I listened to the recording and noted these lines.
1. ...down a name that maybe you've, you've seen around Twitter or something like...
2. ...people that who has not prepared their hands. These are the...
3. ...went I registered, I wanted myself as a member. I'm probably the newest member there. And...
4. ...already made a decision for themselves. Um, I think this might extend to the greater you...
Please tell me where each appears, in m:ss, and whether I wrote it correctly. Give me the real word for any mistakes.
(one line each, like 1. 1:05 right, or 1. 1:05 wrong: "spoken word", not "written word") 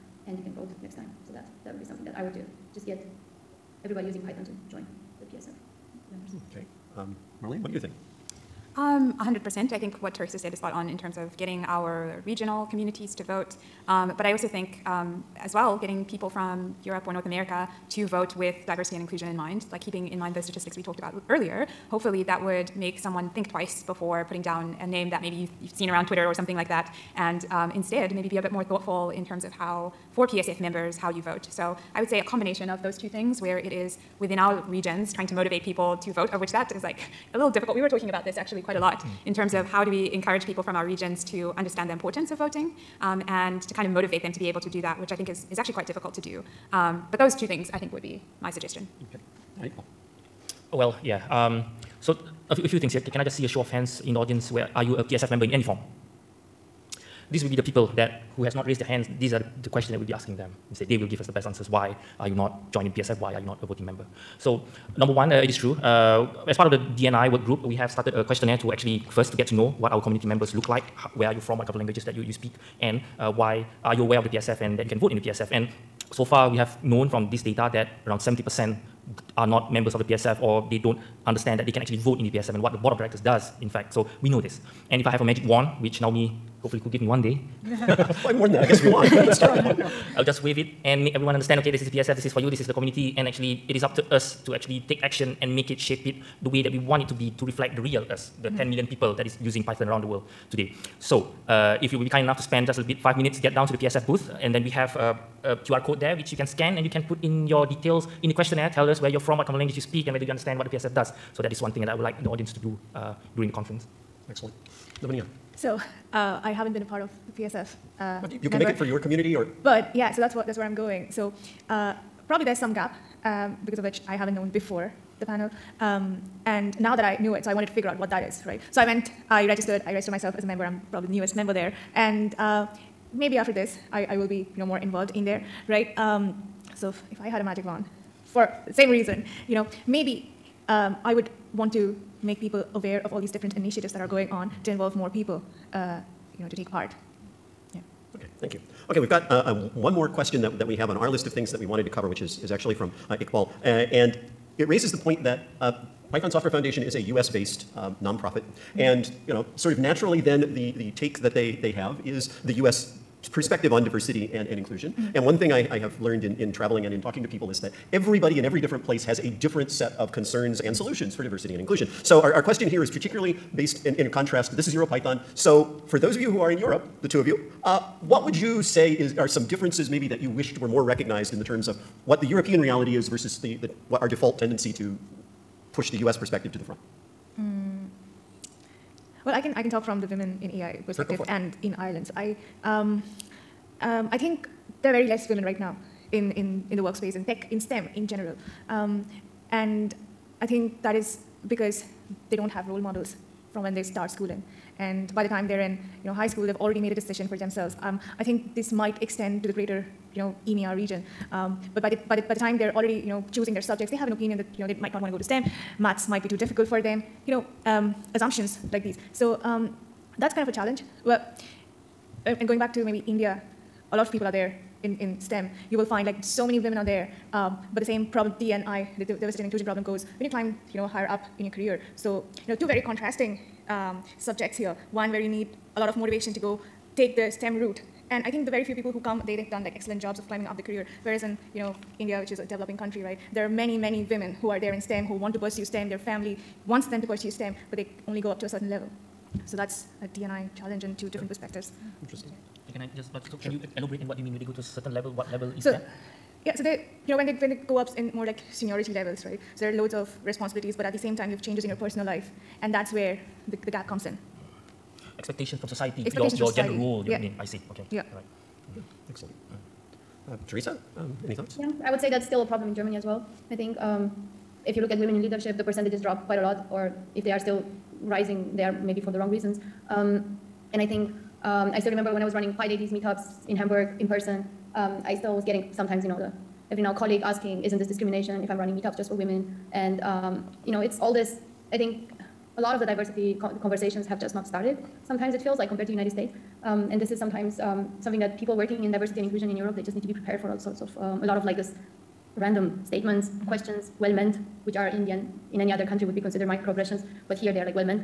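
1. 0:24 right
2. 0:57 wrong: "raised", not "prepared"
3. 2:08 wrong: "registered", not "wanted"
4. 3:26 right.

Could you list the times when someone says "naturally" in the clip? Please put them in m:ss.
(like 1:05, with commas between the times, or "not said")
2:39.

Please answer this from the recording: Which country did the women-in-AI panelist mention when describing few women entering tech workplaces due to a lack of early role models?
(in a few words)
Ireland.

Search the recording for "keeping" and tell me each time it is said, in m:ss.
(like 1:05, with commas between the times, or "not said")
0:19.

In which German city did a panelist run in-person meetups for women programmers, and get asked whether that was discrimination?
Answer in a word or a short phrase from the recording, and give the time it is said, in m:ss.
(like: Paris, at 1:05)
Hamburg, at 4:43.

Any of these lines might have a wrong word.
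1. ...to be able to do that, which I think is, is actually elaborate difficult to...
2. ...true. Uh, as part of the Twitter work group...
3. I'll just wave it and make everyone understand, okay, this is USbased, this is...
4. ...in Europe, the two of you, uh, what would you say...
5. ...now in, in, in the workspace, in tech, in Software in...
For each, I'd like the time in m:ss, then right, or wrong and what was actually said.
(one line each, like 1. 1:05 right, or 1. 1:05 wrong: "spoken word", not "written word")
1. 0:44 wrong: "quite", not "elaborate"
2. 1:05 wrong: "DNI", not "Twitter"
3. 1:30 wrong: "PSF", not "USbased"
4. 2:56 right
5. 3:15 wrong: "STEM", not "Software".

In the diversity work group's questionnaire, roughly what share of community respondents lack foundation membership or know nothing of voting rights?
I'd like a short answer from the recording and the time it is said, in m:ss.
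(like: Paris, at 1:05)
70%, at 1:18.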